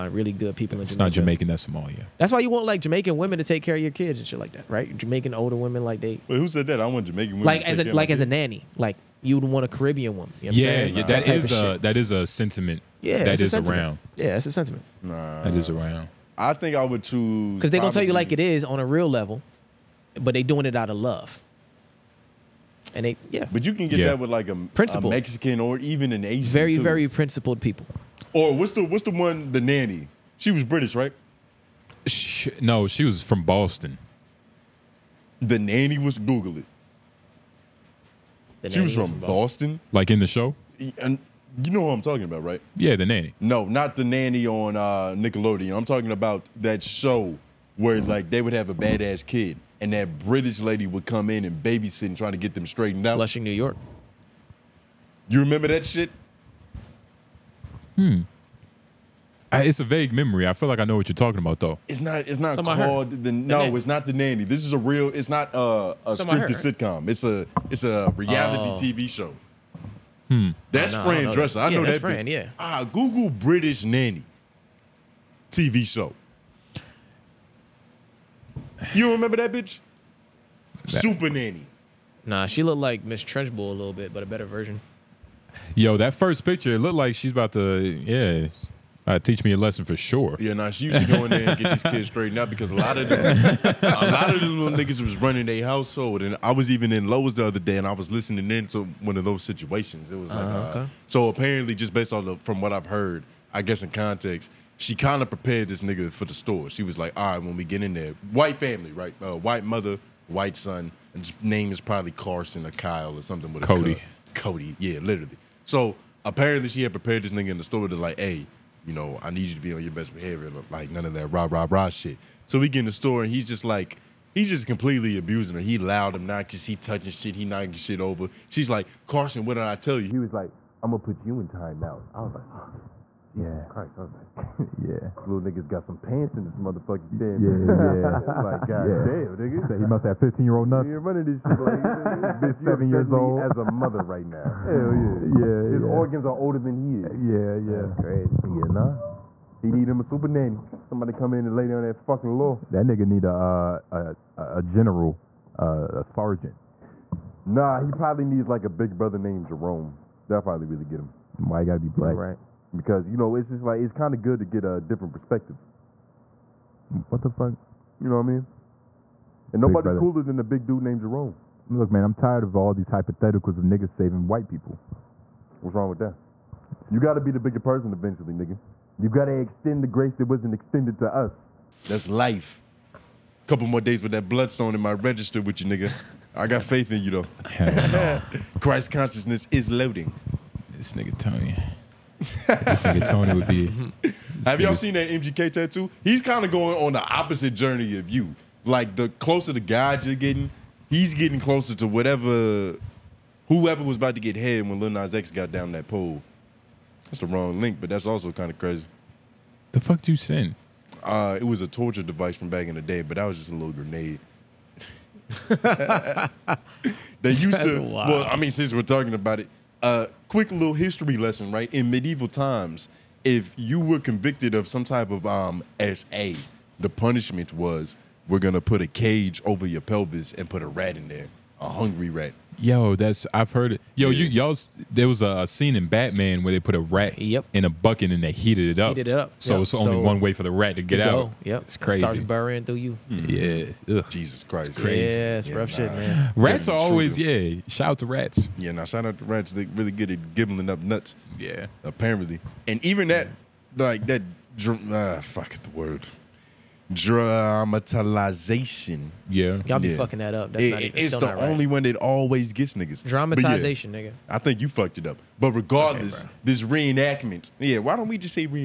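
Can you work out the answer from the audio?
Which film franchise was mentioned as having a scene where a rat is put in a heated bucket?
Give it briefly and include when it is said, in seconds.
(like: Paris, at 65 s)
Batman, at 235 s.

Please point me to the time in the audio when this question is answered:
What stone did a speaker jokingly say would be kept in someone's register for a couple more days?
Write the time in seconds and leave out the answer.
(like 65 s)
184 s.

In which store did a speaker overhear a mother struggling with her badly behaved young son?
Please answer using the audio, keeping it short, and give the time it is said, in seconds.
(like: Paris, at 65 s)
Lowe's, at 97 s.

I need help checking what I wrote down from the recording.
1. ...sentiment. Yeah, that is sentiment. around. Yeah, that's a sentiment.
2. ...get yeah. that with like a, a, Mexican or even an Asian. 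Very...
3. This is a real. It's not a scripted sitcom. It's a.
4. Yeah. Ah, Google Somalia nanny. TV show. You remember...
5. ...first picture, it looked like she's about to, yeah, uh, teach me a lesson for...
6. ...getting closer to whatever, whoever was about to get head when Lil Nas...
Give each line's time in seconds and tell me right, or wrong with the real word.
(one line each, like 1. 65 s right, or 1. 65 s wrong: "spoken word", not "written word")
1. 12 s right
2. 23 s right
3. 64 s right
4. 72 s wrong: "British", not "Somalia"
5. 86 s right
6. 201 s right.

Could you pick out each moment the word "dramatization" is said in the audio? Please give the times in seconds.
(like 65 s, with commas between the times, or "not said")
256 s, 263 s.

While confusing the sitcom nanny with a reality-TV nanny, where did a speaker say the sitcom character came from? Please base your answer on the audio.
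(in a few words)
Flushing, New York.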